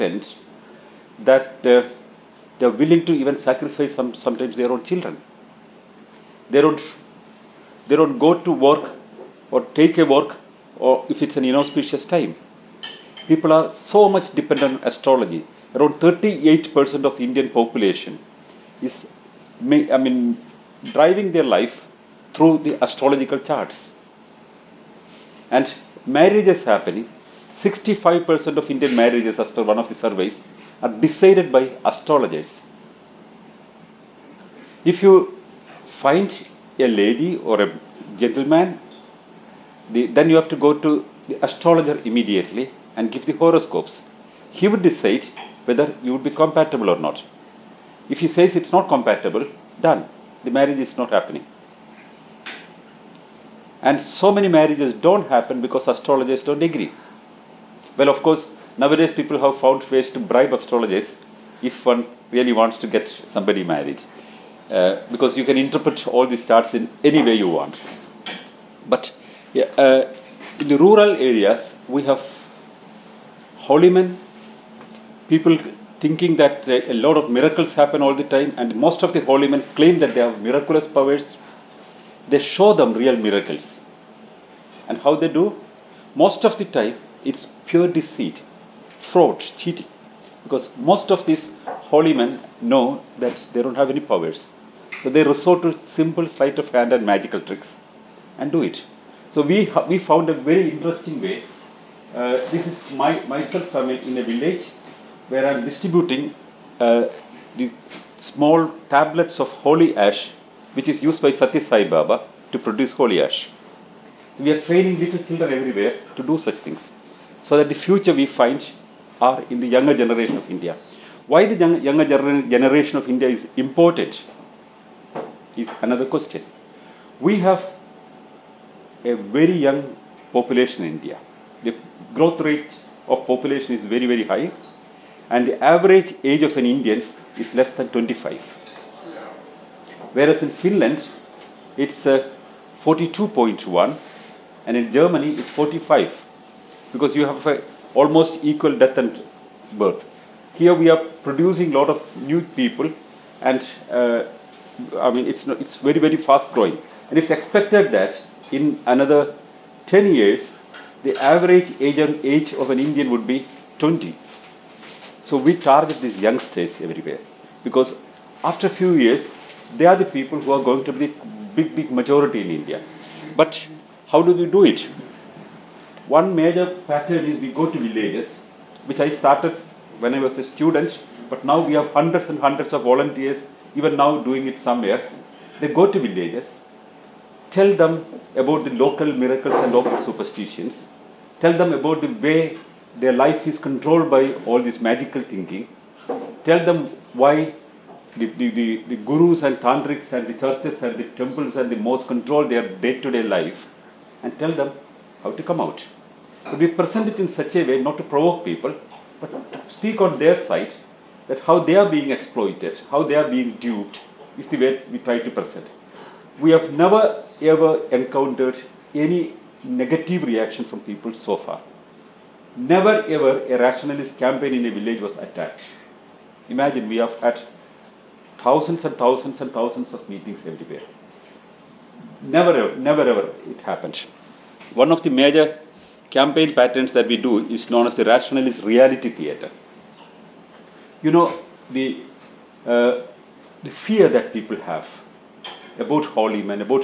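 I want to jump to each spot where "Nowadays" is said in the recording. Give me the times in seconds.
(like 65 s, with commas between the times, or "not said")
58 s.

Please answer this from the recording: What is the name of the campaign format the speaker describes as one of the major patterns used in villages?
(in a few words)
rationalist reality theater.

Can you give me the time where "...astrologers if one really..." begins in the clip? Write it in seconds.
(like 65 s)
60 s.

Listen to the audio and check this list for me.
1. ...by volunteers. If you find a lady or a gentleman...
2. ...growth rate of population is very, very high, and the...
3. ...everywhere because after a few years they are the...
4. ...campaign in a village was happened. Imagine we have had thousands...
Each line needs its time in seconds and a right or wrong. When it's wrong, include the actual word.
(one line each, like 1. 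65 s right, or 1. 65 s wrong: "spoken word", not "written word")
1. 31 s wrong: "astrologers", not "volunteers"
2. 132 s right
3. 166 s right
4. 224 s wrong: "attacked", not "happened".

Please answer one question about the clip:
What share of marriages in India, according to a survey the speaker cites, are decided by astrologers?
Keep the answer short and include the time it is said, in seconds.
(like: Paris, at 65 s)
65%, at 27 s.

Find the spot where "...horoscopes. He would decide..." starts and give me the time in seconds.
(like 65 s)
43 s.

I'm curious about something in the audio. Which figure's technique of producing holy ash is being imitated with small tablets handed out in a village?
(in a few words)
Satya Sai Baba.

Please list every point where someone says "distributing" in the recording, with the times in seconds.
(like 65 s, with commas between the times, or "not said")
105 s.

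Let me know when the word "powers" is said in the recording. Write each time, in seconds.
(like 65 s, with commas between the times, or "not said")
80 s, 94 s.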